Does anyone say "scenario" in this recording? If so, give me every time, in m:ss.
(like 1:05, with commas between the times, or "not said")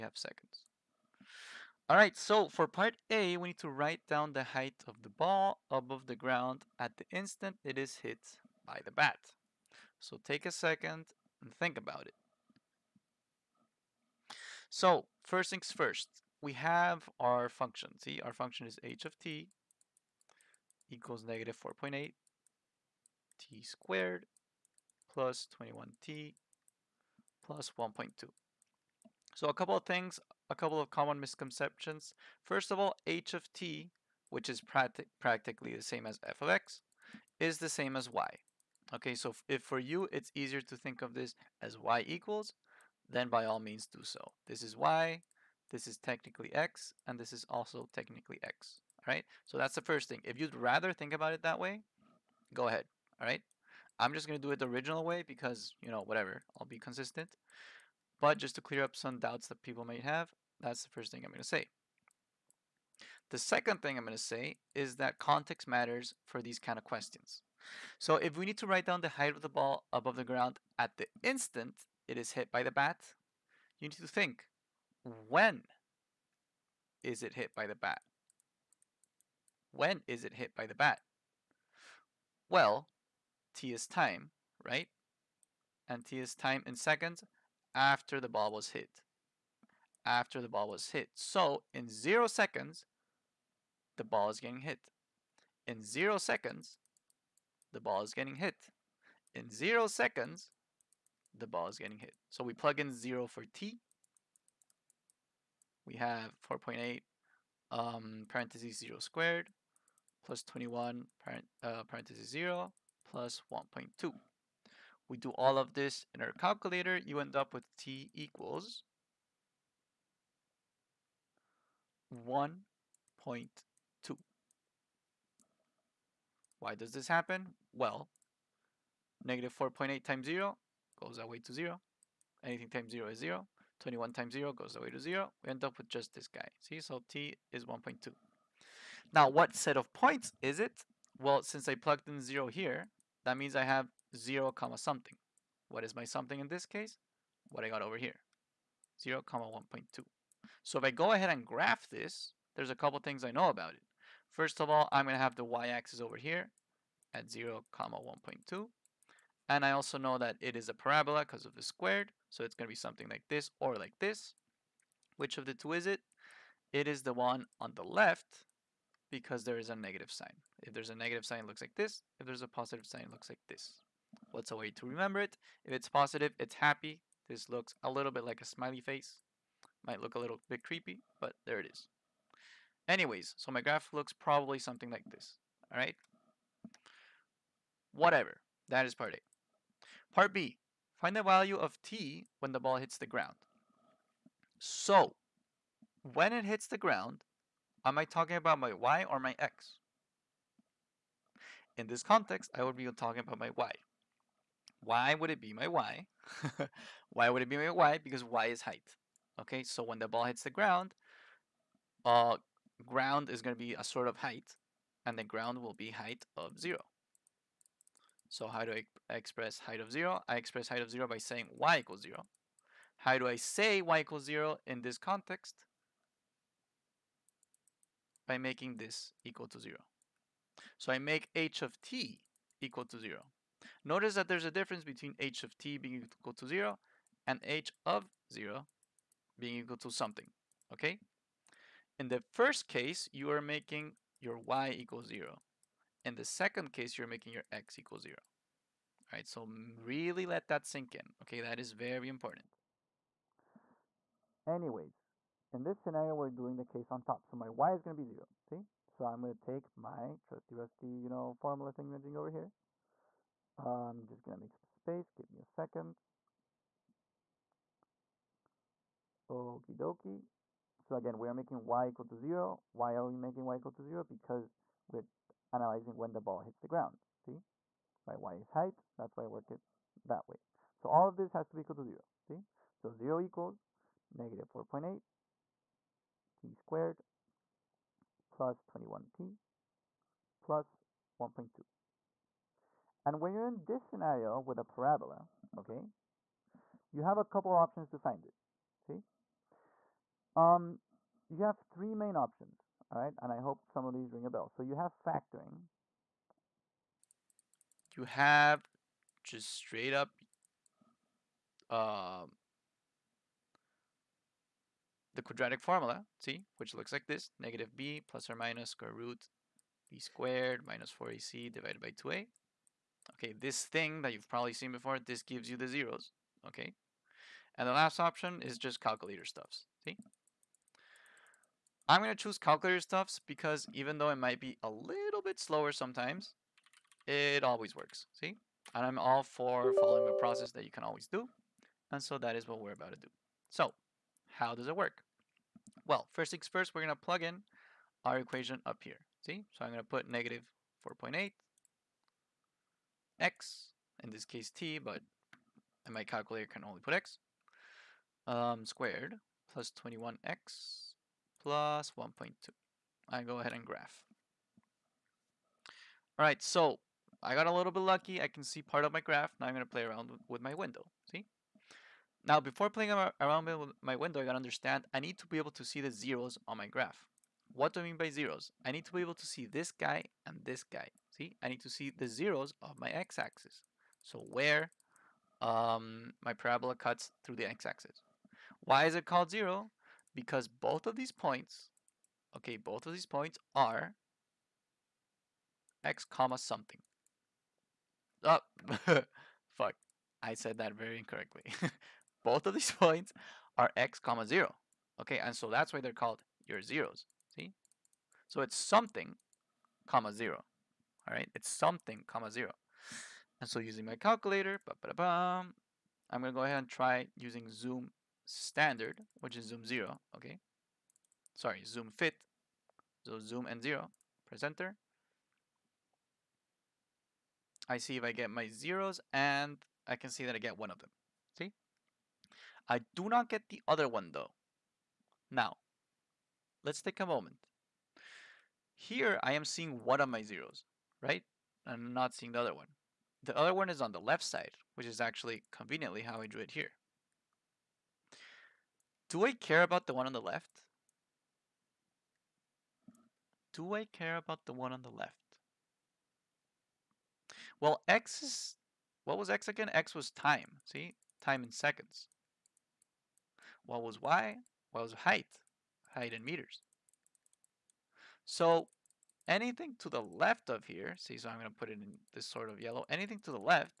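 4:15, 4:53.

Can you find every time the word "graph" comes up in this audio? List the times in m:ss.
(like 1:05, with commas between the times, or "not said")
2:31, 3:03, 6:03, 6:08, 6:16.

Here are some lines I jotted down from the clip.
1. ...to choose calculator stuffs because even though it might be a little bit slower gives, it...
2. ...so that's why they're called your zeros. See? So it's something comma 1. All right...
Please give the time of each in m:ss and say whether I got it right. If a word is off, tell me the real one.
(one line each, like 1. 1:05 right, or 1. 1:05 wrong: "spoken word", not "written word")
1. 5:32 wrong: "sometimes", not "gives"
2. 6:45 wrong: "0", not "1".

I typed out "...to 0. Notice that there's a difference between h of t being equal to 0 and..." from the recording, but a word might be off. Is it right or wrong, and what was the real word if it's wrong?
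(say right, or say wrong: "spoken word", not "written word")
right.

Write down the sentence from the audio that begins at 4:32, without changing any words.
Why are we making y equal to 0?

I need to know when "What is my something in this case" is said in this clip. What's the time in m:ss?
2:25.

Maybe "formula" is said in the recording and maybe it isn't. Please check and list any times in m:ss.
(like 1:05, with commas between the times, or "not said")
4:21, 5:15.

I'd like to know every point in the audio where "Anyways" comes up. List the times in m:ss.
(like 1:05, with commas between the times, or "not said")
3:02, 4:14.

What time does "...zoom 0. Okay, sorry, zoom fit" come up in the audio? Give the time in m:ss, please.
6:59.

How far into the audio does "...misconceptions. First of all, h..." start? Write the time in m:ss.
0:31.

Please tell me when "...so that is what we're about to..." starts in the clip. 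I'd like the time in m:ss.
5:42.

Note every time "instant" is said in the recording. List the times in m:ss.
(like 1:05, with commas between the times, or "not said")
0:07, 1:11.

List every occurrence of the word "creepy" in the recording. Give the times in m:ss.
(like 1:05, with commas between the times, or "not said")
3:00.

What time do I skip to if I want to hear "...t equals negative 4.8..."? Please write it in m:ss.
0:19.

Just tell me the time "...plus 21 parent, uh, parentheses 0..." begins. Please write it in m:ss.
1:50.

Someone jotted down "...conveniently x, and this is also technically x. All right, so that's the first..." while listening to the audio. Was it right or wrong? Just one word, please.
wrong.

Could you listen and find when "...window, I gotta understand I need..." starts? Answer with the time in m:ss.
6:13.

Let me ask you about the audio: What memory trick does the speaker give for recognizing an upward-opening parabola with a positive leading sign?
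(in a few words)
It's happy.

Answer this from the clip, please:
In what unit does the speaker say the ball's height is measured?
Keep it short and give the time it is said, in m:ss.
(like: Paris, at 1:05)
meters, at 7:46.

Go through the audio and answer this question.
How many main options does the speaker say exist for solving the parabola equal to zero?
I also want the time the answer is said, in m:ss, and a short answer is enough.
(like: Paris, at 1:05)
3, at 5:01.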